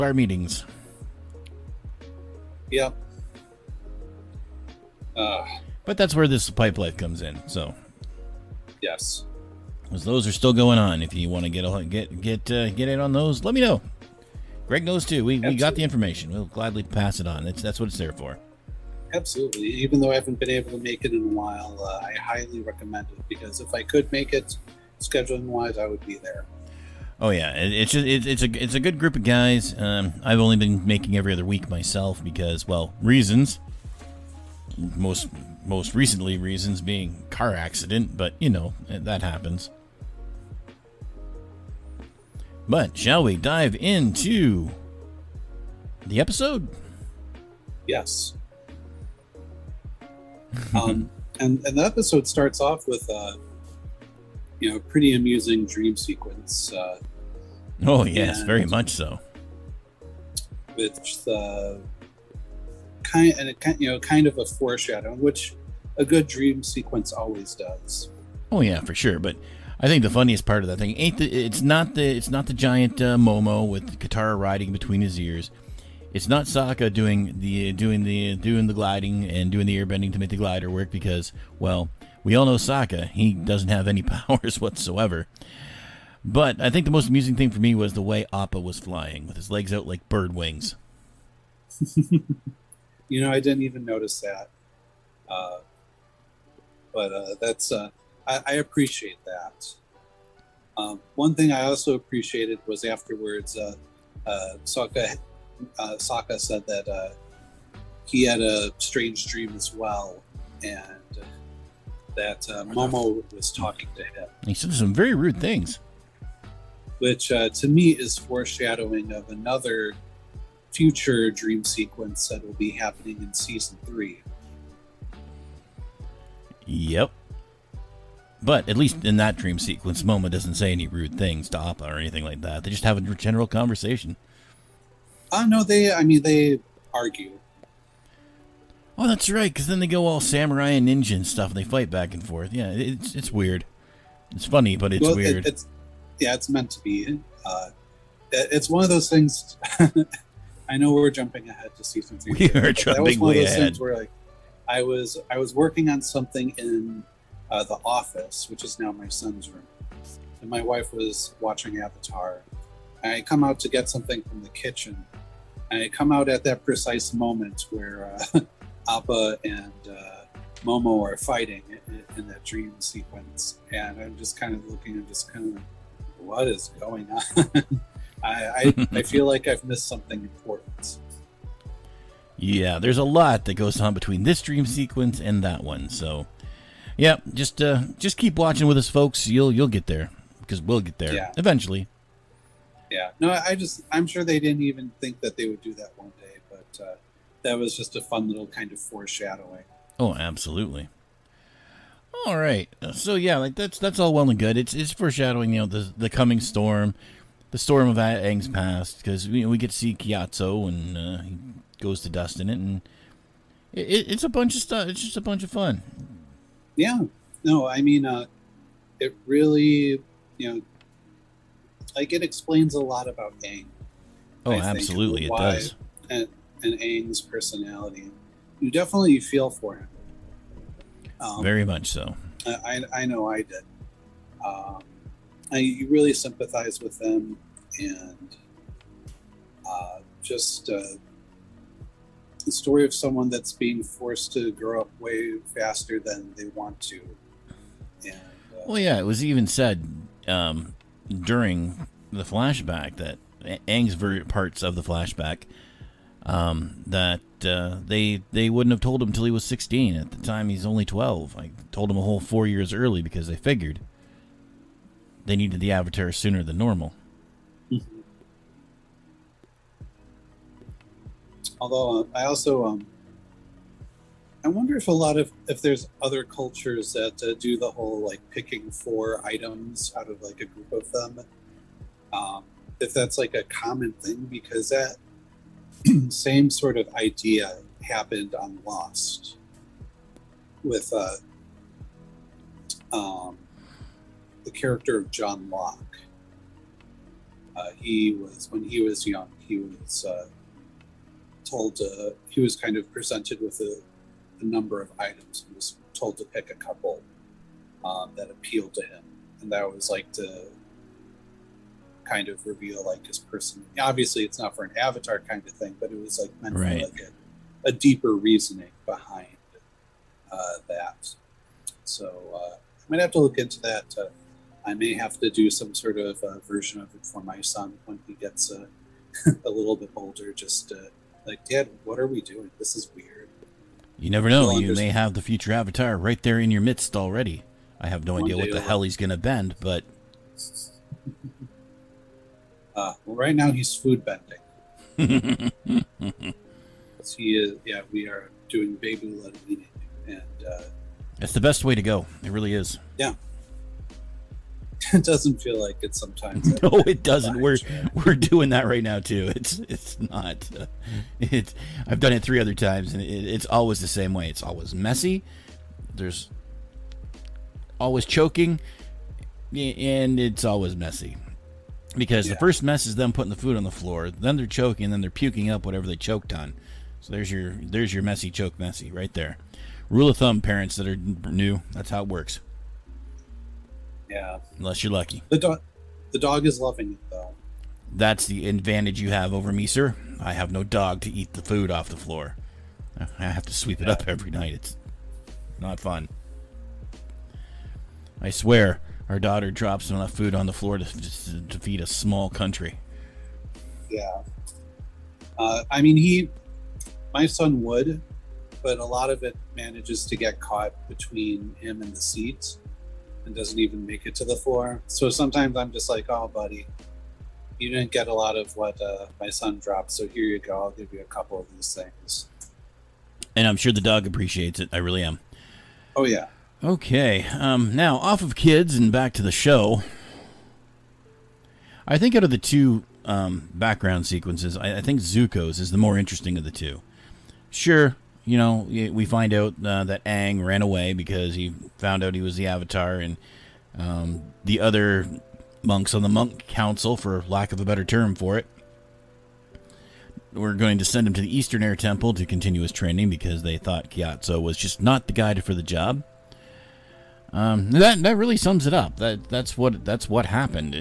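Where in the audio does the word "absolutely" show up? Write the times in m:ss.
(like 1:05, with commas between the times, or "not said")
0:19, 3:20, 3:44.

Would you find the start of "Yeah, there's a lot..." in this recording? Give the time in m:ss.
3:02.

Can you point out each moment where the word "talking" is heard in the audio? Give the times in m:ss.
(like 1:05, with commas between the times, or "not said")
1:53.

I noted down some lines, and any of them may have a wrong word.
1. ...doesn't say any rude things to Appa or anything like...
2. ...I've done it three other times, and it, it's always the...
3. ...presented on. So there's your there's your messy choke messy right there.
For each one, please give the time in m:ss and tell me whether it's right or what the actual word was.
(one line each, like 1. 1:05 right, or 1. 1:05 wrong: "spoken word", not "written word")
1. 2:10 right
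2. 6:01 right
3. 6:15 wrong: "choked", not "presented".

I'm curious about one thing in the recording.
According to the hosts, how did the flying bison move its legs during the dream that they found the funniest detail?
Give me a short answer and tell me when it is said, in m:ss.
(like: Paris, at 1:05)
like bird wings, at 1:29.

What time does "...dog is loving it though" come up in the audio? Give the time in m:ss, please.
6:26.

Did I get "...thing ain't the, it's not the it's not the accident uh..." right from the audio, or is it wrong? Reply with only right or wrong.
wrong.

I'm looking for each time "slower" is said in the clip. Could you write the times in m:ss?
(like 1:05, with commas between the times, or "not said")
not said.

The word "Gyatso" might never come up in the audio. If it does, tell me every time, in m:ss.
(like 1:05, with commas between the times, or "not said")
3:29, 7:33.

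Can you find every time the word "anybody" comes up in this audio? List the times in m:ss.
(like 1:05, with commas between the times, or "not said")
not said.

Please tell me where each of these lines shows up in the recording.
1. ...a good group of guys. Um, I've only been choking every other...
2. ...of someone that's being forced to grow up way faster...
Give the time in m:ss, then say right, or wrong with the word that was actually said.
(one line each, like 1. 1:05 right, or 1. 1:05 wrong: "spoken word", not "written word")
1. 0:28 wrong: "making", not "choking"
2. 4:02 right.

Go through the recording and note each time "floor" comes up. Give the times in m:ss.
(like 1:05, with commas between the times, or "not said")
6:13, 6:31, 6:40, 6:54.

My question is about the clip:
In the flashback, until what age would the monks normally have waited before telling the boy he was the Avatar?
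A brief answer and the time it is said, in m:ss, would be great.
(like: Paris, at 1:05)
16, at 4:19.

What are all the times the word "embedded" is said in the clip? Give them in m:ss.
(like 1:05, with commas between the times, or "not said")
not said.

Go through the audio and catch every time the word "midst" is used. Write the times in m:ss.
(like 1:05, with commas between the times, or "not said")
5:36.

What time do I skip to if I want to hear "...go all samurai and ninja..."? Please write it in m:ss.
2:19.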